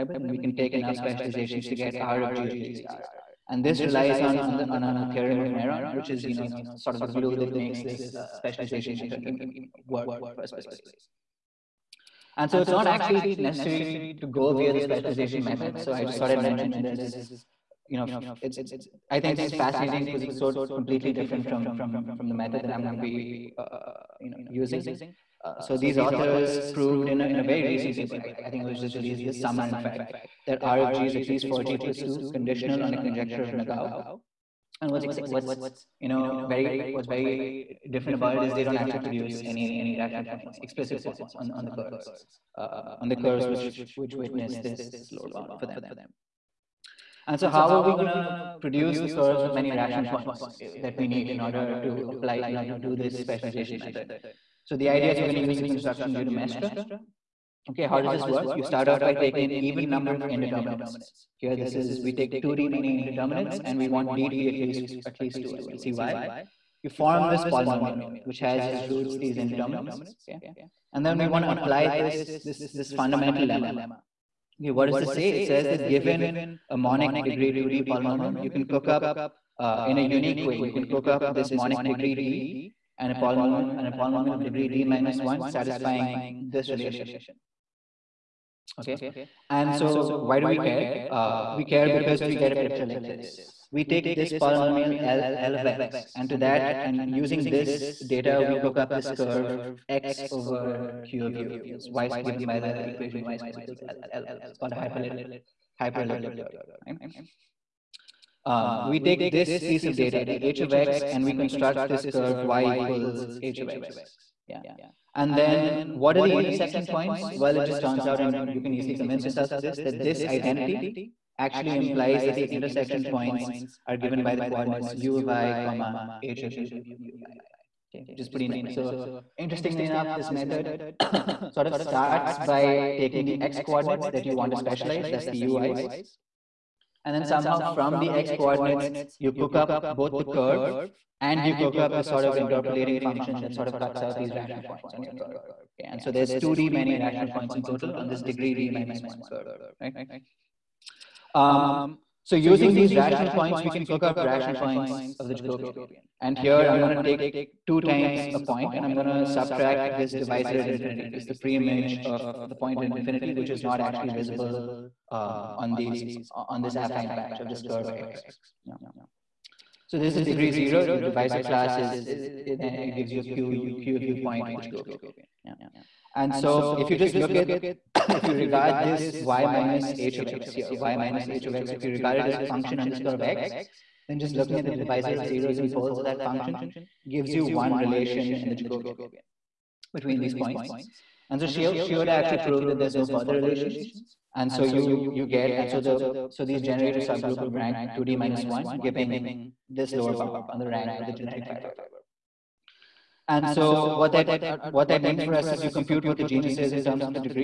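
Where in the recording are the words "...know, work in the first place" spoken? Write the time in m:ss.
0:09.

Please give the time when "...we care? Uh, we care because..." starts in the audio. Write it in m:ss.
1:30.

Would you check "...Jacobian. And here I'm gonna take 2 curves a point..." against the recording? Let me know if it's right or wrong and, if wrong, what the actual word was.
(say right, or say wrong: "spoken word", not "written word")
wrong: "times", not "curves".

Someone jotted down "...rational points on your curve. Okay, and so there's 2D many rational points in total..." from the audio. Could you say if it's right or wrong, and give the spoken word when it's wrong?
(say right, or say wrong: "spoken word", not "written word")
right.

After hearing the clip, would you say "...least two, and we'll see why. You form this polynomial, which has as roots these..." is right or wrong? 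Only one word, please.
right.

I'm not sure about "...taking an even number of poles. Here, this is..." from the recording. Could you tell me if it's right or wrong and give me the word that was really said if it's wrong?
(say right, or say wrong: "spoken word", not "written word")
wrong: "indeterminates", not "poles".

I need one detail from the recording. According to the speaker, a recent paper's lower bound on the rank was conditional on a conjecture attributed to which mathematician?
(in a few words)
Nagao.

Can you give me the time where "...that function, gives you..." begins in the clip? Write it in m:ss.
3:06.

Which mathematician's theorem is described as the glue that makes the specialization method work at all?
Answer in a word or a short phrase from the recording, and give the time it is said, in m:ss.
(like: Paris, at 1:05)
Neron, at 0:05.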